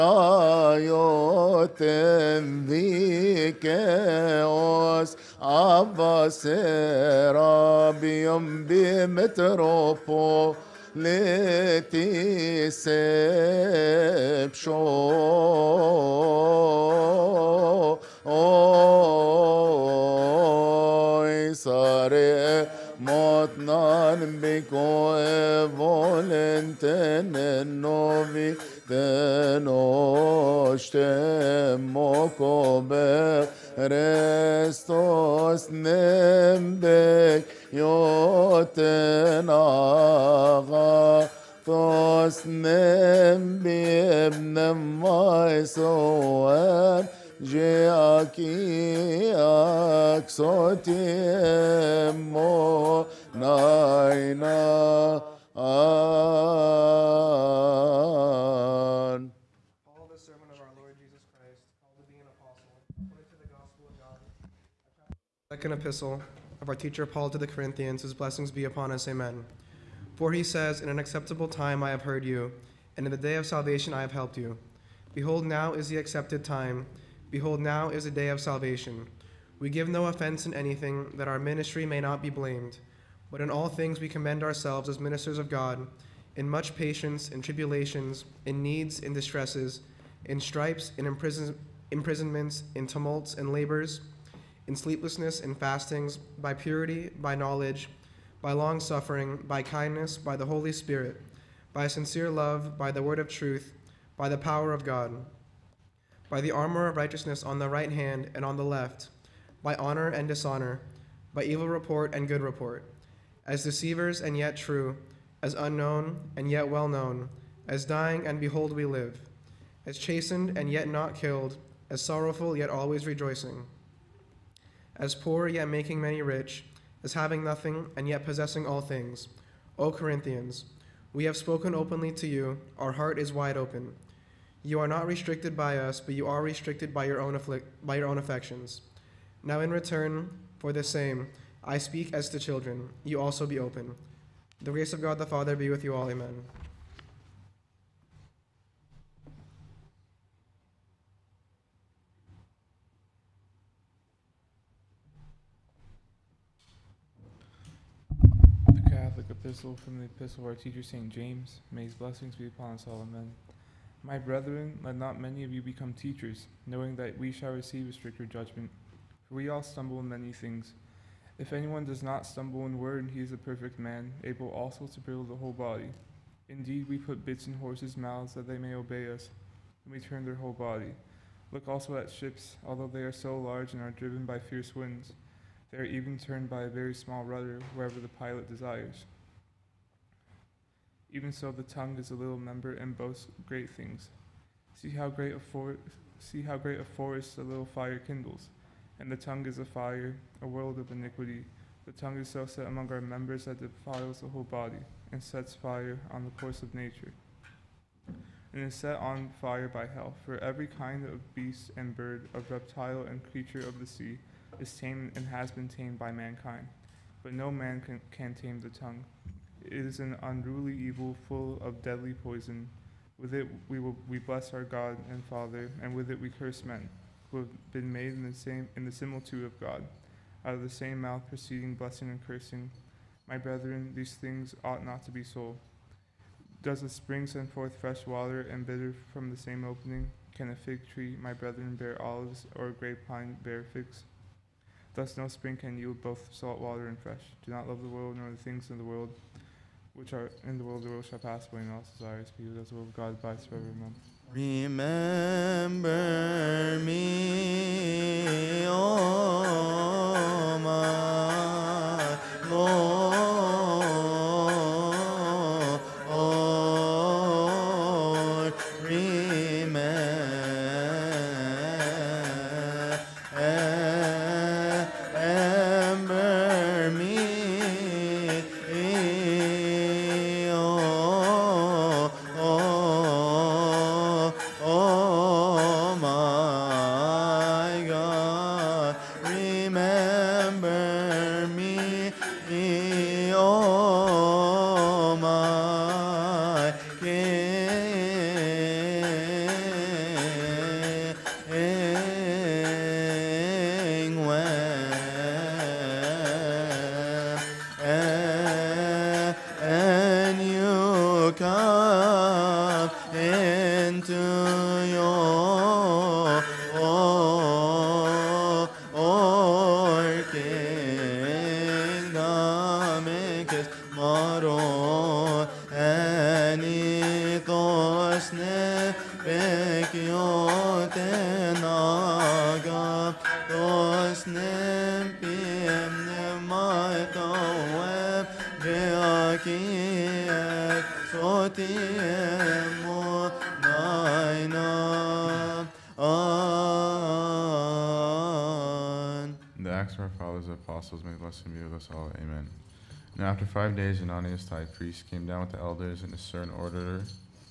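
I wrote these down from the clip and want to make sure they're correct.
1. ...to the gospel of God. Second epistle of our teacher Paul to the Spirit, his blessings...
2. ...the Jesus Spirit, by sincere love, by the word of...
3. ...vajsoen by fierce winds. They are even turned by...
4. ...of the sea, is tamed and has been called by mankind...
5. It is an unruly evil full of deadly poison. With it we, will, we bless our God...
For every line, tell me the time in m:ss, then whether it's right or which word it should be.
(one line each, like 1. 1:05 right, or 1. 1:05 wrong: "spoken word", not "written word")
1. 1:03 wrong: "Corinthians", not "Spirit"
2. 1:40 wrong: "Holy", not "Jesus"
3. 3:03 wrong: "driven", not "vajsoen"
4. 3:33 wrong: "tamed", not "called"
5. 3:39 right.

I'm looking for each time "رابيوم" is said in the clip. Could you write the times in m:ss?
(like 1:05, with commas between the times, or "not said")
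0:07.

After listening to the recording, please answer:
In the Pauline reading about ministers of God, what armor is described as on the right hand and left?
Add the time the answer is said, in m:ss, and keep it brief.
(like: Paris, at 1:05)
armor of righteousness, at 1:46.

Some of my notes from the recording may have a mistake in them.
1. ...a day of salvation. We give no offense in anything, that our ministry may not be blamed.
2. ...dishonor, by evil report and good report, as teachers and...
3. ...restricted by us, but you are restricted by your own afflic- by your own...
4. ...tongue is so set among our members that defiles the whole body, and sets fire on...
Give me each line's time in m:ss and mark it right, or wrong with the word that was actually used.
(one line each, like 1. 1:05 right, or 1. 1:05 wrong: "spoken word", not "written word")
1. 1:18 right
2. 1:50 wrong: "deceivers", not "teachers"
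3. 2:15 right
4. 3:21 right.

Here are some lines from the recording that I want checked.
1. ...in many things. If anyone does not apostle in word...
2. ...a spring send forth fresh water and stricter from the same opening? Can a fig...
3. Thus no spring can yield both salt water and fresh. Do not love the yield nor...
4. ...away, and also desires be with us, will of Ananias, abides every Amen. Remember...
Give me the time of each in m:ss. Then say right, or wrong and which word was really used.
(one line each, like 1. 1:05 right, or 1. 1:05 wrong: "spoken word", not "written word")
1. 2:49 wrong: "stumble", not "apostle"
2. 3:56 wrong: "bitter", not "stricter"
3. 4:04 wrong: "world", not "yield"
4. 4:11 wrong: "God", not "Ananias".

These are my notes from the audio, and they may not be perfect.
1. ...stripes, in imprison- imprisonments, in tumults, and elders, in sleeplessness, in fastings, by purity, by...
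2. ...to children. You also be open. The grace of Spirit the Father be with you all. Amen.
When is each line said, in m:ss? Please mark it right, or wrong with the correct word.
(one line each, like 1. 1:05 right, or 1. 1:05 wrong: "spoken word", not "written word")
1. 1:30 wrong: "labors", not "elders"
2. 2:22 wrong: "God", not "Spirit".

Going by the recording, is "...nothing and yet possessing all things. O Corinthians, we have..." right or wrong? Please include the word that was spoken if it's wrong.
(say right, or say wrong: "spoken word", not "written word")
right.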